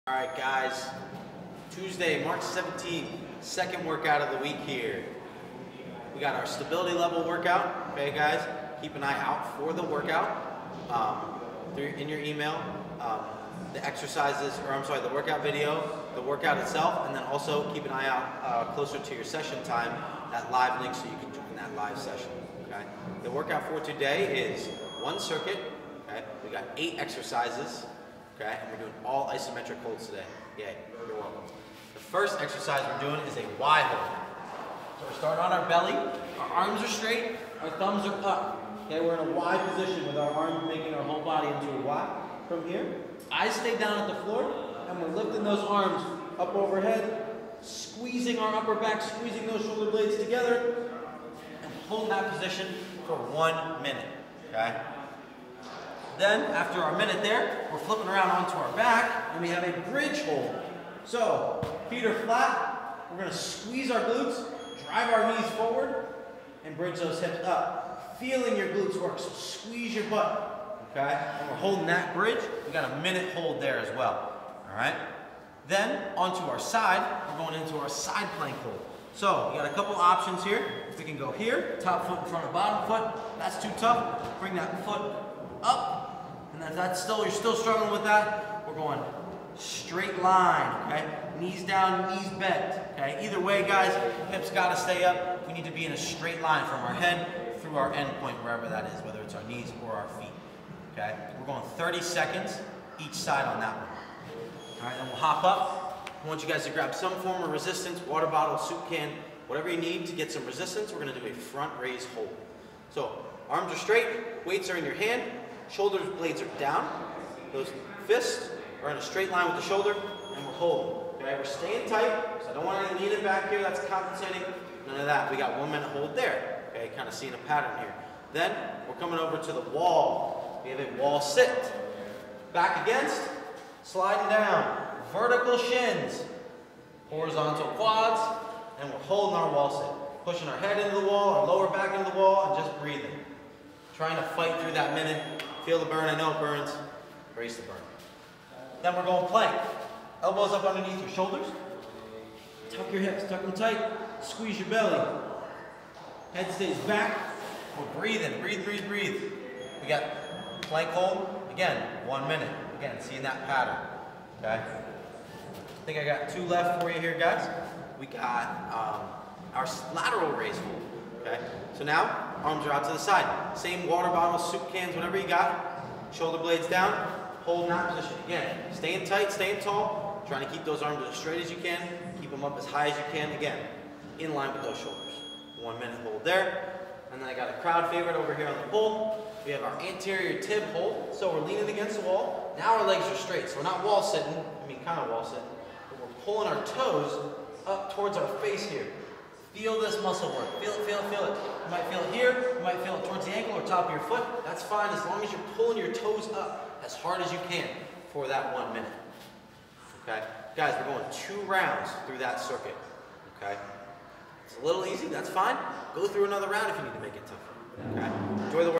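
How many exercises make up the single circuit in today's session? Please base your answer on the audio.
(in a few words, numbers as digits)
8.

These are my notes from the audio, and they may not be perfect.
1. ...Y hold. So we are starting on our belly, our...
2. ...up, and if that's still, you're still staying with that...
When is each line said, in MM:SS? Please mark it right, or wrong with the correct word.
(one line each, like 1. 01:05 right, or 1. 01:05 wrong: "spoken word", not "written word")
1. 00:33 right
2. 01:25 wrong: "struggling", not "staying".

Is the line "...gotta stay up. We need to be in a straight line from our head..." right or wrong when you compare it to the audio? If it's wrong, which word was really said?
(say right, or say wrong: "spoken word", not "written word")
right.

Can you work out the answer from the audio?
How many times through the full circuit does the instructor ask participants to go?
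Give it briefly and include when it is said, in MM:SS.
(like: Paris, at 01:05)
2 rounds, at 03:31.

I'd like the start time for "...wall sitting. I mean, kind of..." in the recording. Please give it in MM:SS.
03:13.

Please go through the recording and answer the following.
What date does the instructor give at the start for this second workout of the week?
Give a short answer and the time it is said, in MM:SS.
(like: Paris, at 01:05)
Tuesday, March 17th, at 00:01.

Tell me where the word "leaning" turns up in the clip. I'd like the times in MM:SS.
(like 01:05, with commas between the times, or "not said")
02:03, 03:11.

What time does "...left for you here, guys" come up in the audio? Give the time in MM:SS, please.
02:46.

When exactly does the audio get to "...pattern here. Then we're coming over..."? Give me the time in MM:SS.
02:07.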